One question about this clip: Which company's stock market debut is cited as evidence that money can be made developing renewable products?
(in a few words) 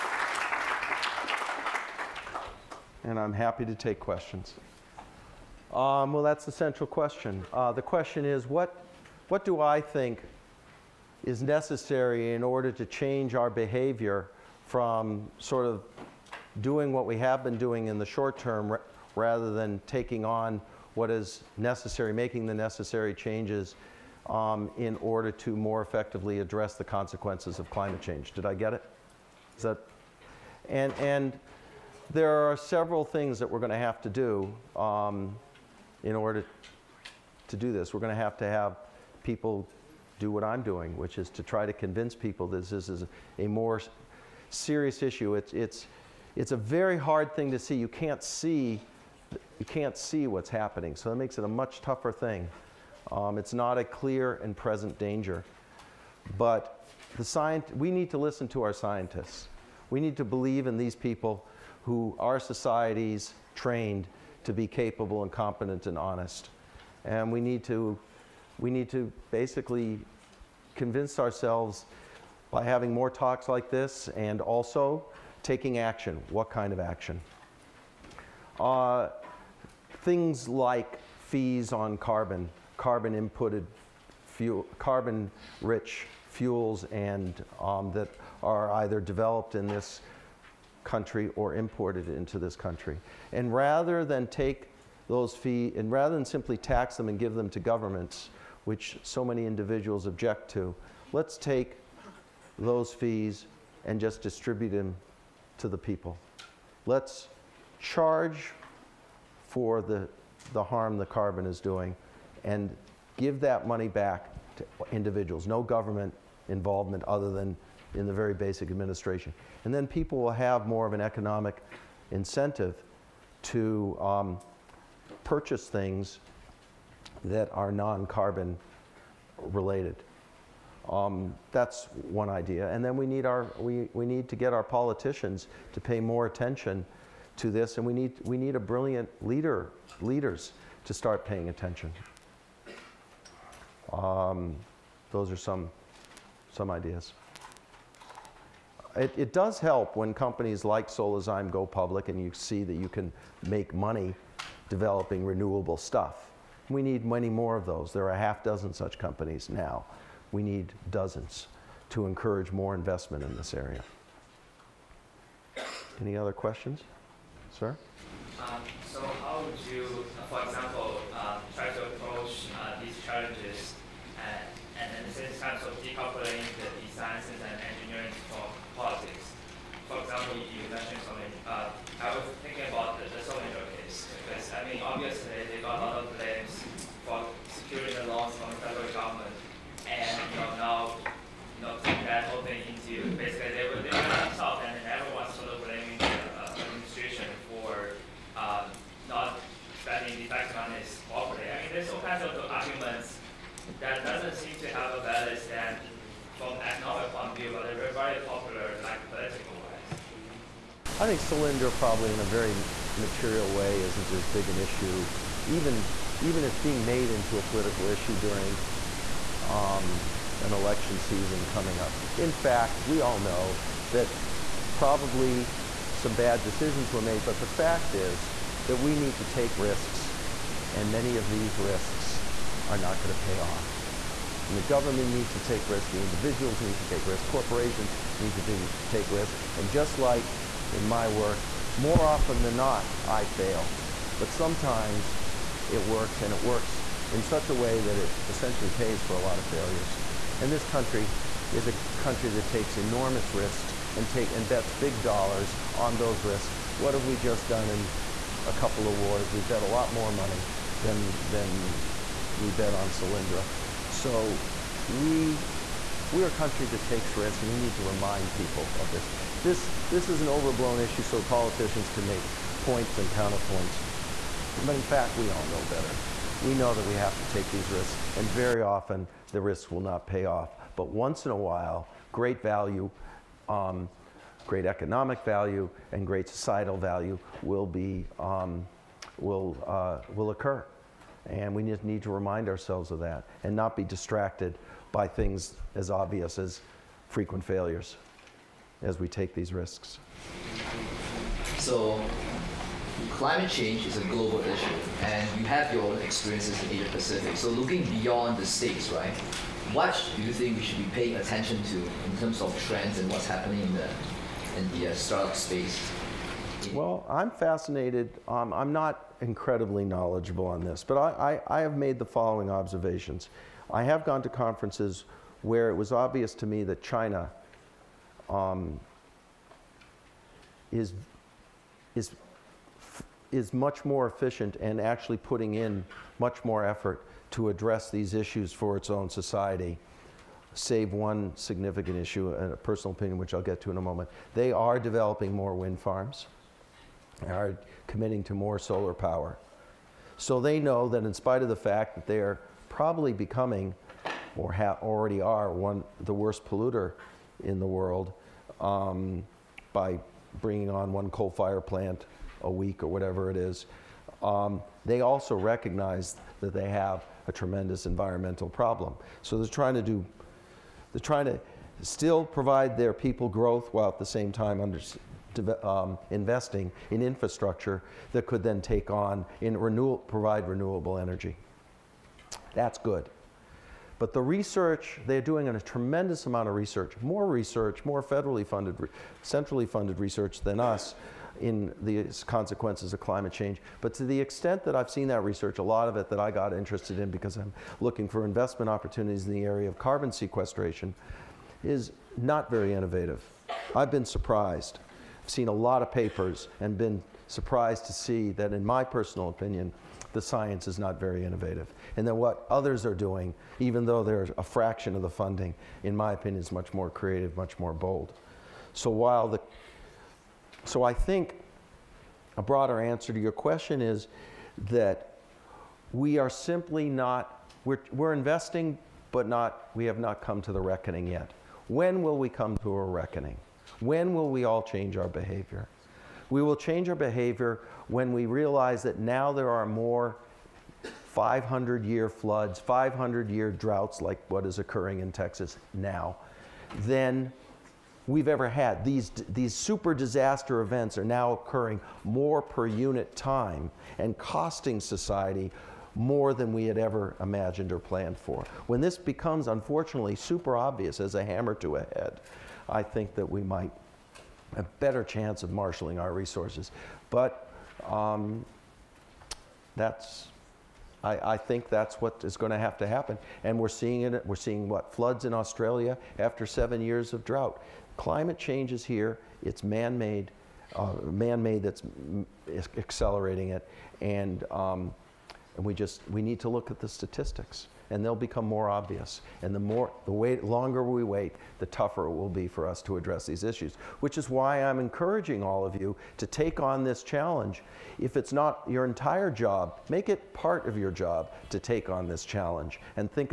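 Solazyme.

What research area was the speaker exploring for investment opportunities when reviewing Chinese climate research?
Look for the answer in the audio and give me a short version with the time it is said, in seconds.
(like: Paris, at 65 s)
carbon sequestration, at 399 s.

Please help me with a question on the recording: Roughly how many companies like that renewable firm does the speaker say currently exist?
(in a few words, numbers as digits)
a half dozen.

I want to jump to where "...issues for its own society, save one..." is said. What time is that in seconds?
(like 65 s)
338 s.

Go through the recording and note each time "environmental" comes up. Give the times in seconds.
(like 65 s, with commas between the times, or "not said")
367 s.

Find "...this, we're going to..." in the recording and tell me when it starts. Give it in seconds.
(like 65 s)
37 s.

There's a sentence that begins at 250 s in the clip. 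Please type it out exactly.
And this country is a country that takes enormous risks and, take, and bets big dollars on those risks.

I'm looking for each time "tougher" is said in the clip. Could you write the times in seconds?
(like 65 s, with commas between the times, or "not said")
51 s, 491 s.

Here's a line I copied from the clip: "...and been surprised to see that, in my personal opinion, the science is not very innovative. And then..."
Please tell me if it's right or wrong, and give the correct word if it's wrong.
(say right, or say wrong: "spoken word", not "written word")
right.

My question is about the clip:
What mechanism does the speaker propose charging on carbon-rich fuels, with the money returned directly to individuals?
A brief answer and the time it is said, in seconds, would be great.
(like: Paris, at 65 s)
fees on carbon, at 81 s.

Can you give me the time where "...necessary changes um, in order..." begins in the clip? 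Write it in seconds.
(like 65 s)
22 s.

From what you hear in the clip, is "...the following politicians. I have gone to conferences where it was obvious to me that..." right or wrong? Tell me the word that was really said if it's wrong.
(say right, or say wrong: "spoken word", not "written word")
wrong: "observations", not "politicians".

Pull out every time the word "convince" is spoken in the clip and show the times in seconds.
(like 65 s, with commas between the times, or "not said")
41 s, 70 s.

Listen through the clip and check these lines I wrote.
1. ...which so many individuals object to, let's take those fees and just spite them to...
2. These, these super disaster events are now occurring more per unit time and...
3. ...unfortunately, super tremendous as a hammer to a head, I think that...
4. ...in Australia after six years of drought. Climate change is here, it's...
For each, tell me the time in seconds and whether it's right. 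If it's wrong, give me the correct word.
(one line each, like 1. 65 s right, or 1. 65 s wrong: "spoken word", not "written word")
1. 98 s wrong: "distribute", not "spite"
2. 448 s right
3. 459 s wrong: "obvious", not "tremendous"
4. 475 s wrong: "seven", not "six".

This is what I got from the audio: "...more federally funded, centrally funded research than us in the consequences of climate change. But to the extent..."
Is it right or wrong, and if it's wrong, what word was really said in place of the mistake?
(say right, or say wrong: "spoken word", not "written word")
right.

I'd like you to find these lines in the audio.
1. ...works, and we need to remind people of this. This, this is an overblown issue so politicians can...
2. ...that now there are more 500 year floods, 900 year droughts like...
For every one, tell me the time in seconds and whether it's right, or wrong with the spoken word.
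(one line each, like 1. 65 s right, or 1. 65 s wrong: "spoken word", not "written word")
1. 267 s wrong: "risks", not "works"
2. 438 s wrong: "500", not "900".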